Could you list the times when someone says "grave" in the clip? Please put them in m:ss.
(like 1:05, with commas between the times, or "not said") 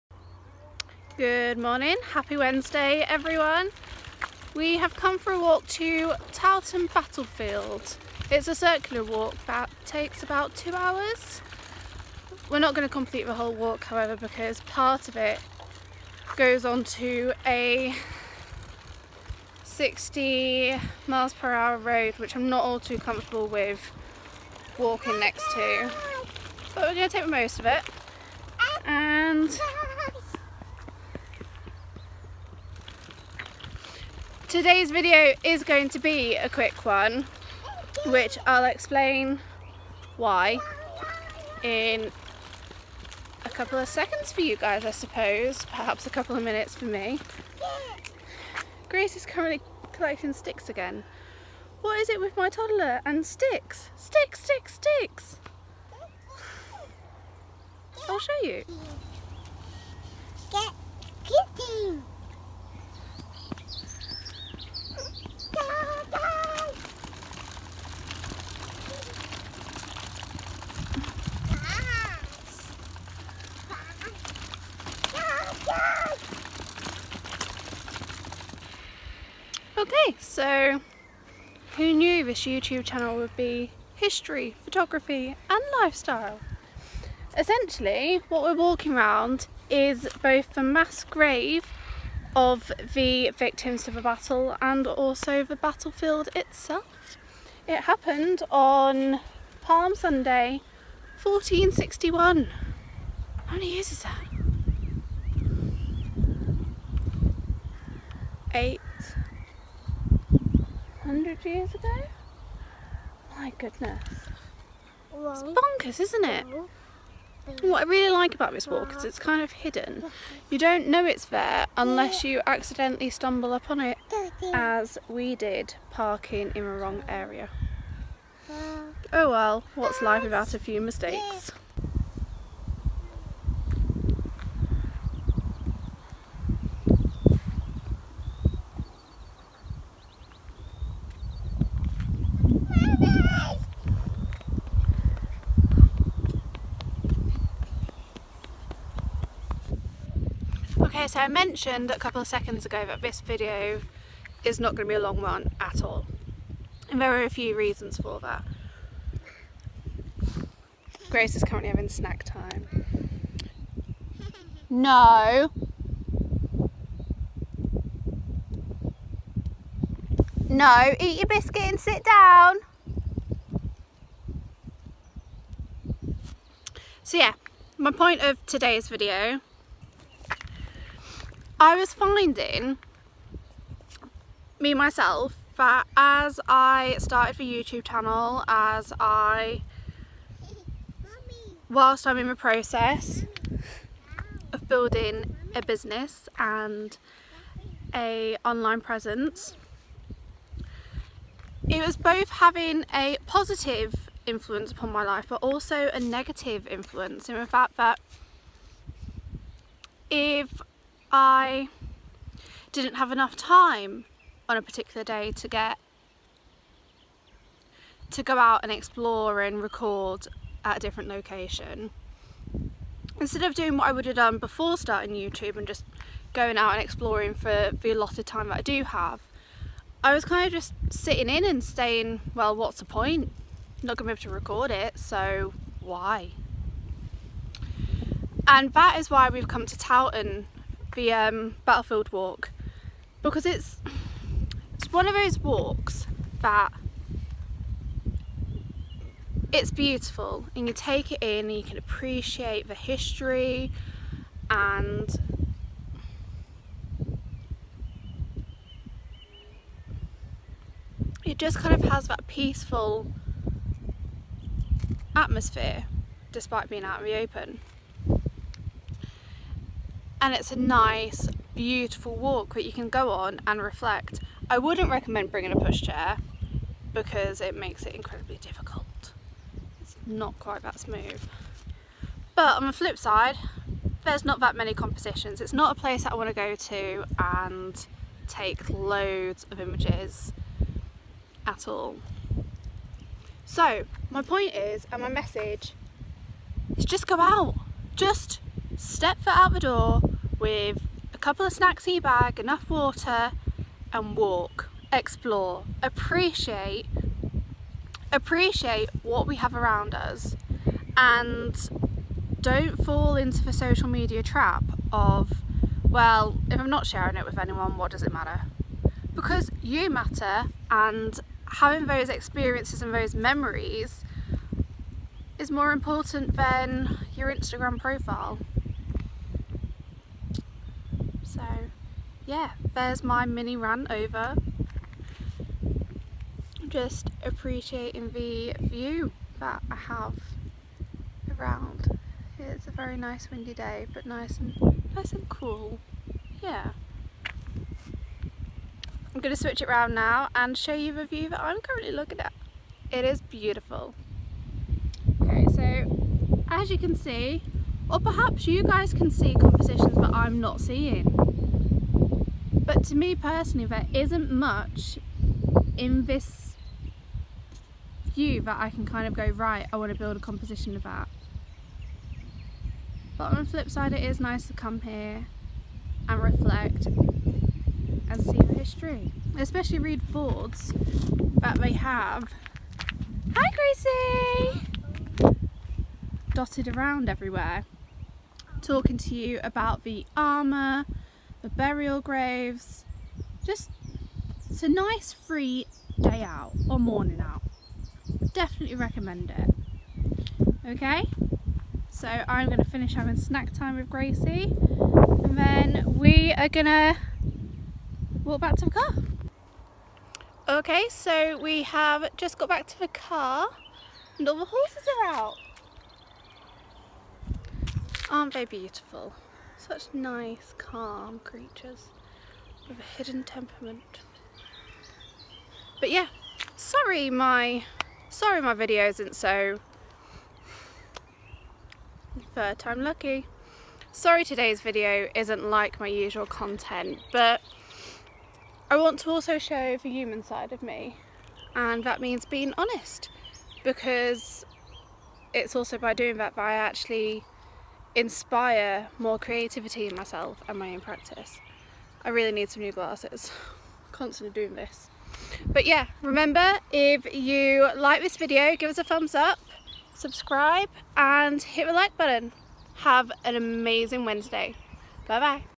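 1:31, 6:32.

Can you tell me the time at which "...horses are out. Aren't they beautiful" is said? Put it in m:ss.
6:54.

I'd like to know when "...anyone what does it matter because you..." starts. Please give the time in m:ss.
5:17.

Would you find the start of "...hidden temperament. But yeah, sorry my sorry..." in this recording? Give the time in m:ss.
7:02.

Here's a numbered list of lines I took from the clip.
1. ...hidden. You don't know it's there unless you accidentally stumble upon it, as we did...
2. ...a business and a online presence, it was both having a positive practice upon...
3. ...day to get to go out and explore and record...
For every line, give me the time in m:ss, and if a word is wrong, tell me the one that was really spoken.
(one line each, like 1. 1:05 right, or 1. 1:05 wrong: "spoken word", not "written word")
1. 1:59 right
2. 3:15 wrong: "influence", not "practice"
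3. 3:35 right.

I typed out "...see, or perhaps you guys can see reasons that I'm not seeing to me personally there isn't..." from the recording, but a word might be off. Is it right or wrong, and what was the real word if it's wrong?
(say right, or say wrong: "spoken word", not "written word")
wrong: "compositions", not "reasons".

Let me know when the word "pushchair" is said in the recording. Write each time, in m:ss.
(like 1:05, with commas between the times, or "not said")
4:35.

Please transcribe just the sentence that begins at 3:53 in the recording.
I'm not gonna be able to record it, so why?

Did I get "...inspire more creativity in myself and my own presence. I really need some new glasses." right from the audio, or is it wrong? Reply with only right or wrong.
wrong.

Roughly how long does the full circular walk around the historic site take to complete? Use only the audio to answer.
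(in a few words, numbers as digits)
two hours.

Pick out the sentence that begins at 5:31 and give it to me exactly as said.
So yeah, there's my mini run over.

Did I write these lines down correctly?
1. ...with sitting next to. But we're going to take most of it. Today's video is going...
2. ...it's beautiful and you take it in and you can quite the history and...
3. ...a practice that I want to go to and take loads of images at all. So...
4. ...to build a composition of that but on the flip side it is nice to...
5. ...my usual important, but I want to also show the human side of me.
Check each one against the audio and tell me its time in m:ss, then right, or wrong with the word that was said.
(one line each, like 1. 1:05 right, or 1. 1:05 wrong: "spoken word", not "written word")
1. 0:23 wrong: "walking", not "sitting"
2. 4:09 wrong: "appreciate", not "quite"
3. 4:45 wrong: "place", not "practice"
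4. 6:09 right
5. 7:15 wrong: "content", not "important".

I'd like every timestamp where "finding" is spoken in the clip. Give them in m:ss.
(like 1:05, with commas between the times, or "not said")
3:01.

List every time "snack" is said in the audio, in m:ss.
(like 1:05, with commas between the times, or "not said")
2:41, 5:01, 6:43.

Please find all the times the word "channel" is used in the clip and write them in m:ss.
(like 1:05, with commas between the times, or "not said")
1:22, 3:07.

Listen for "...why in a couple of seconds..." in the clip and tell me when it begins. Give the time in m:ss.
0:40.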